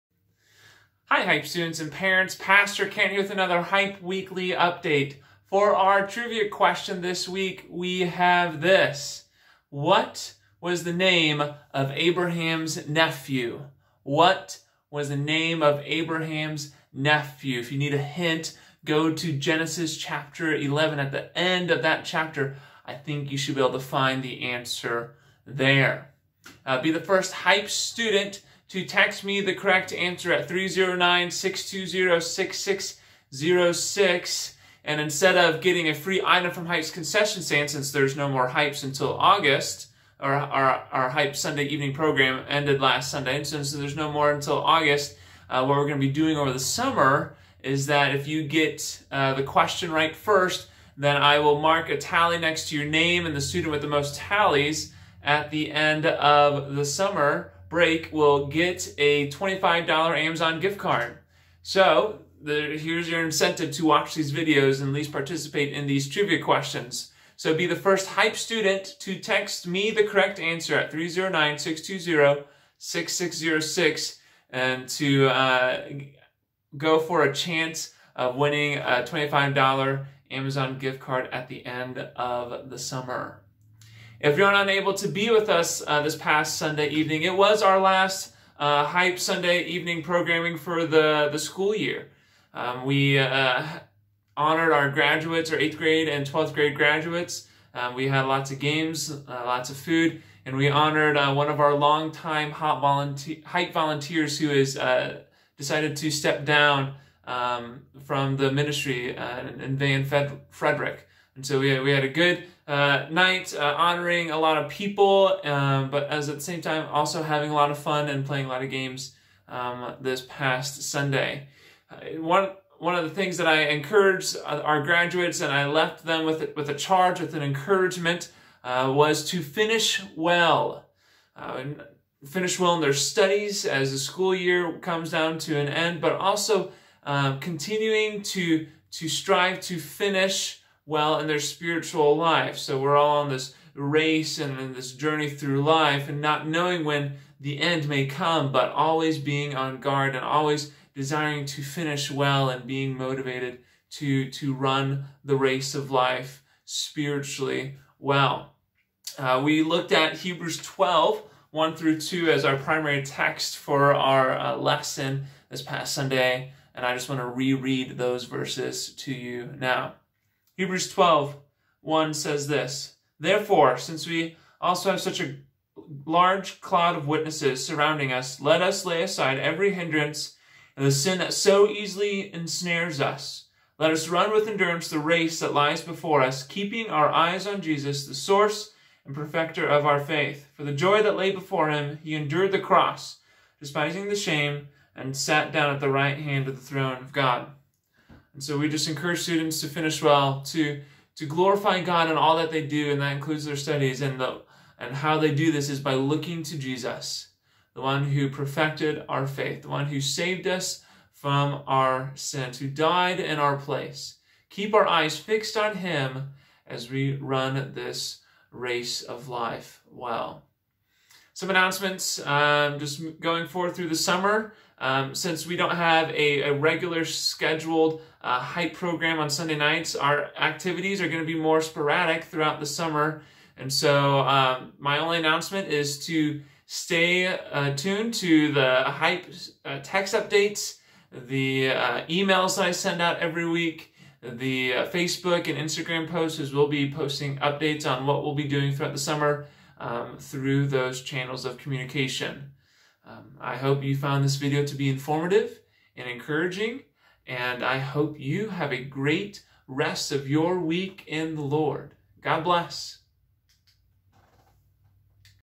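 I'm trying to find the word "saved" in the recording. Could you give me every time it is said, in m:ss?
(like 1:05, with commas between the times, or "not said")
3:30.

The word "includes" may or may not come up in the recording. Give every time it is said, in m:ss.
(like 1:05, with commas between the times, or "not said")
3:23.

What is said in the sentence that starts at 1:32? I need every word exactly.
Um, we uh, honored our graduates, our 8th grade and 12th grade graduates.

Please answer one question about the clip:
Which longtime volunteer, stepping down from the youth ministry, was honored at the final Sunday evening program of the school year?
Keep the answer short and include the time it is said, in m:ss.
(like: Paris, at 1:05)
Van Frederick, at 1:49.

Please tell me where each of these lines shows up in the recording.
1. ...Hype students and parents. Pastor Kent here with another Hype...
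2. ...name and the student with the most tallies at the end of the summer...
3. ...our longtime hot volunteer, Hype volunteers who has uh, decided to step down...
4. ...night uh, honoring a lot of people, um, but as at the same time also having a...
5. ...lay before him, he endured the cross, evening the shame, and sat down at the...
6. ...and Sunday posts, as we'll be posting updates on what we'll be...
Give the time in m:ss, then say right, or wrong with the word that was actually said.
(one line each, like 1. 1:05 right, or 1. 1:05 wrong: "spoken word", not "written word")
1. 0:01 right
2. 0:52 right
3. 1:41 right
4. 1:53 right
5. 3:11 wrong: "despising", not "evening"
6. 4:05 wrong: "Instagram", not "Sunday".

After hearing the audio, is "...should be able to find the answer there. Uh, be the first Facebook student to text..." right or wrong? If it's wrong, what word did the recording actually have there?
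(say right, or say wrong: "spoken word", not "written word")
wrong: "Hype", not "Facebook".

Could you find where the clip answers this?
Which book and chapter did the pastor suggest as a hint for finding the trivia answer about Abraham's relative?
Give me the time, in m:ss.
0:19.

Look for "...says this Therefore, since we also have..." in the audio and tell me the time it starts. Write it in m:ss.
2:52.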